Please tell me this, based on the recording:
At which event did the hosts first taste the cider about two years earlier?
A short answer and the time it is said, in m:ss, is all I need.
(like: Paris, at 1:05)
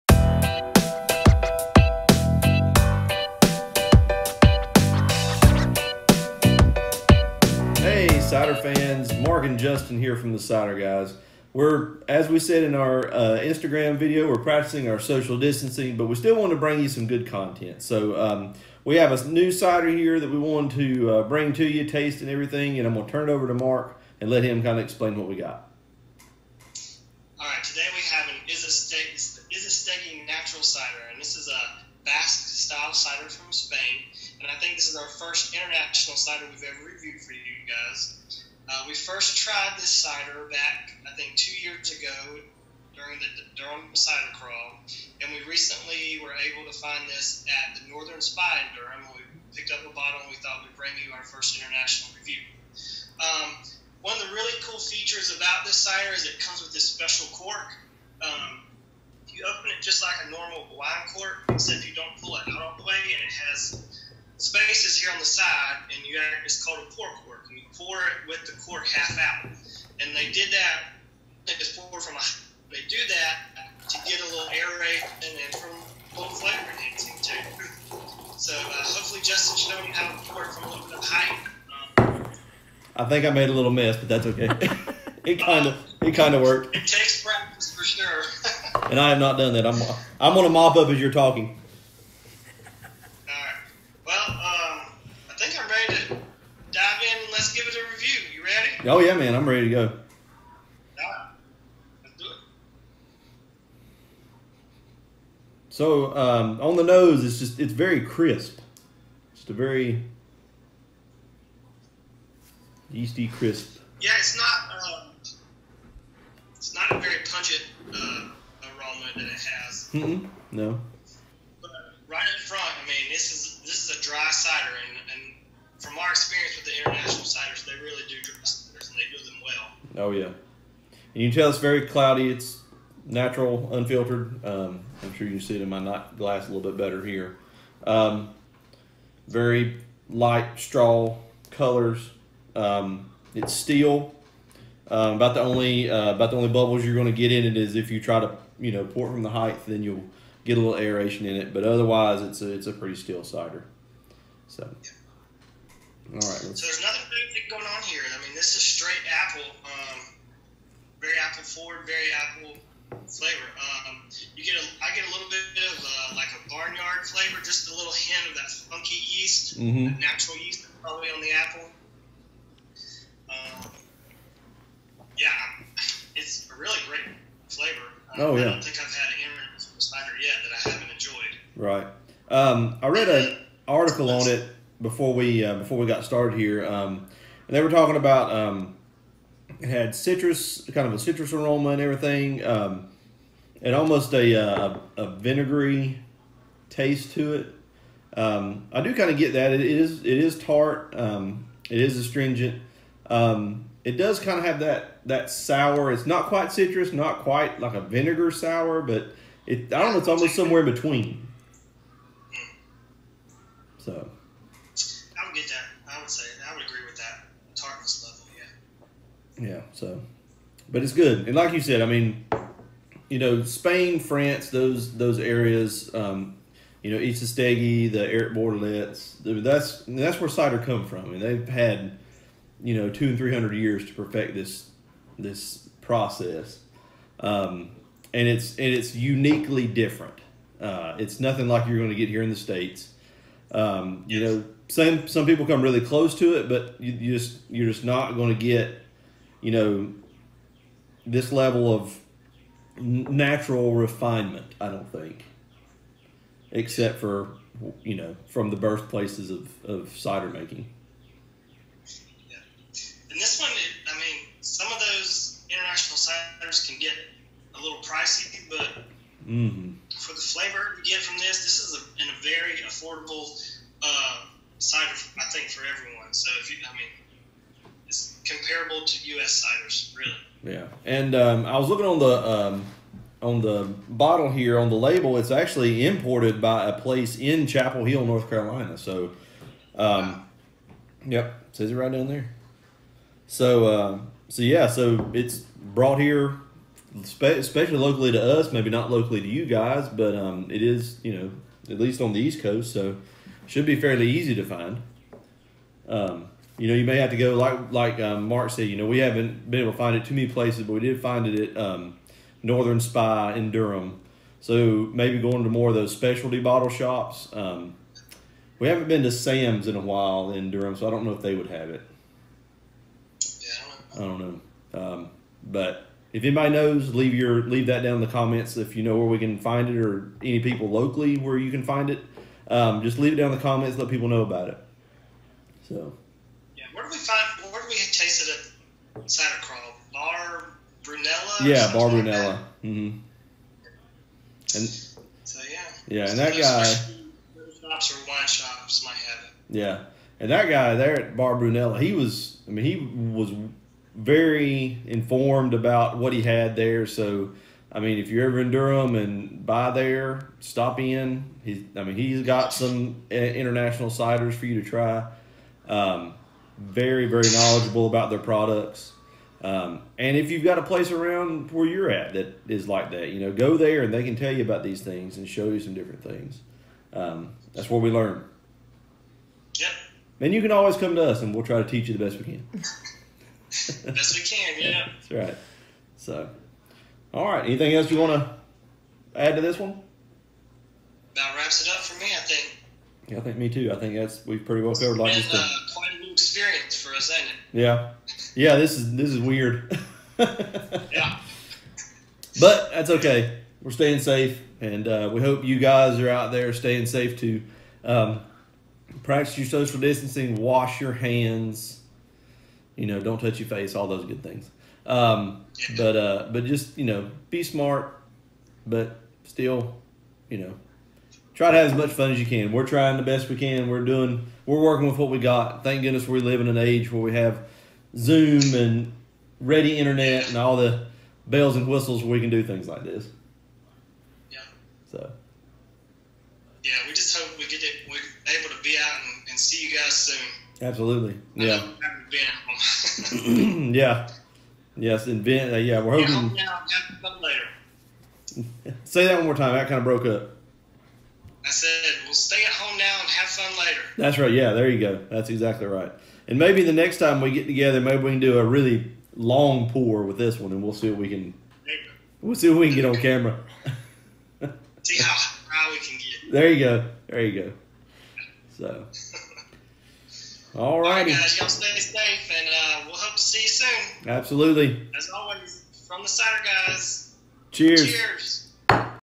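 Durham Cider Crawl, at 0:43.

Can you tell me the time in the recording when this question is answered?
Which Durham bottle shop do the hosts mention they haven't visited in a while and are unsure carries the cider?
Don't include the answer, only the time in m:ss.
5:19.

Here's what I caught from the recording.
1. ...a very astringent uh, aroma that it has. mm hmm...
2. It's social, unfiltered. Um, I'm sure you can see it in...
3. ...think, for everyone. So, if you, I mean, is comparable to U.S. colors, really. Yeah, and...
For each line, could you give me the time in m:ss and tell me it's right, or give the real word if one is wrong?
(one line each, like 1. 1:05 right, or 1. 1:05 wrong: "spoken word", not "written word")
1. 1:56 wrong: "pungent", not "astringent"
2. 2:12 wrong: "natural", not "social"
3. 4:35 wrong: "ciders", not "colors".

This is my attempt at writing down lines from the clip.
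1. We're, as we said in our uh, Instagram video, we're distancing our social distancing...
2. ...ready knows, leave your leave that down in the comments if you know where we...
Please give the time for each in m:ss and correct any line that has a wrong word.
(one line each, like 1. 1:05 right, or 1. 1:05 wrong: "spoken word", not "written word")
1. 0:11 wrong: "practicing", not "distancing"
2. 5:26 wrong: "anybody", not "ready".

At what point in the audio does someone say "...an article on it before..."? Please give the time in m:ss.
3:03.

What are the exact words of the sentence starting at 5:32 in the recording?
Um, just leave it down in the comments.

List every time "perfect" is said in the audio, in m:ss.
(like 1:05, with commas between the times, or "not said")
3:53.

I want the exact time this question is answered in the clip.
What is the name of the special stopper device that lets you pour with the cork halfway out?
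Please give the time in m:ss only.
1:06.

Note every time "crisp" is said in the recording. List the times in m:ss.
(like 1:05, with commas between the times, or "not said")
1:48, 1:53.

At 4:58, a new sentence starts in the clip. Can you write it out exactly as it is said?
Maybe not locally to you guys, but um, it is you know at least on the East Coast.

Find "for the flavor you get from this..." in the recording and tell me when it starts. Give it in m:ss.
4:29.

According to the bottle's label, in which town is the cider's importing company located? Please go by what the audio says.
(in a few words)
Chapel Hill, North Carolina.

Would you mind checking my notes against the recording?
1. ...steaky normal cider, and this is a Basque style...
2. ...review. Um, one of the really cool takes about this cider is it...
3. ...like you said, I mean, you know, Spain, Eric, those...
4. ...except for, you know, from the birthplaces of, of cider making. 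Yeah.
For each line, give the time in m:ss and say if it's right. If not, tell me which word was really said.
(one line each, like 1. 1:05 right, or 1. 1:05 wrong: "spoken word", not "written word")
1. 0:28 wrong: "natural", not "normal"
2. 0:52 wrong: "features", not "takes"
3. 3:41 wrong: "France", not "Eric"
4. 4:16 right.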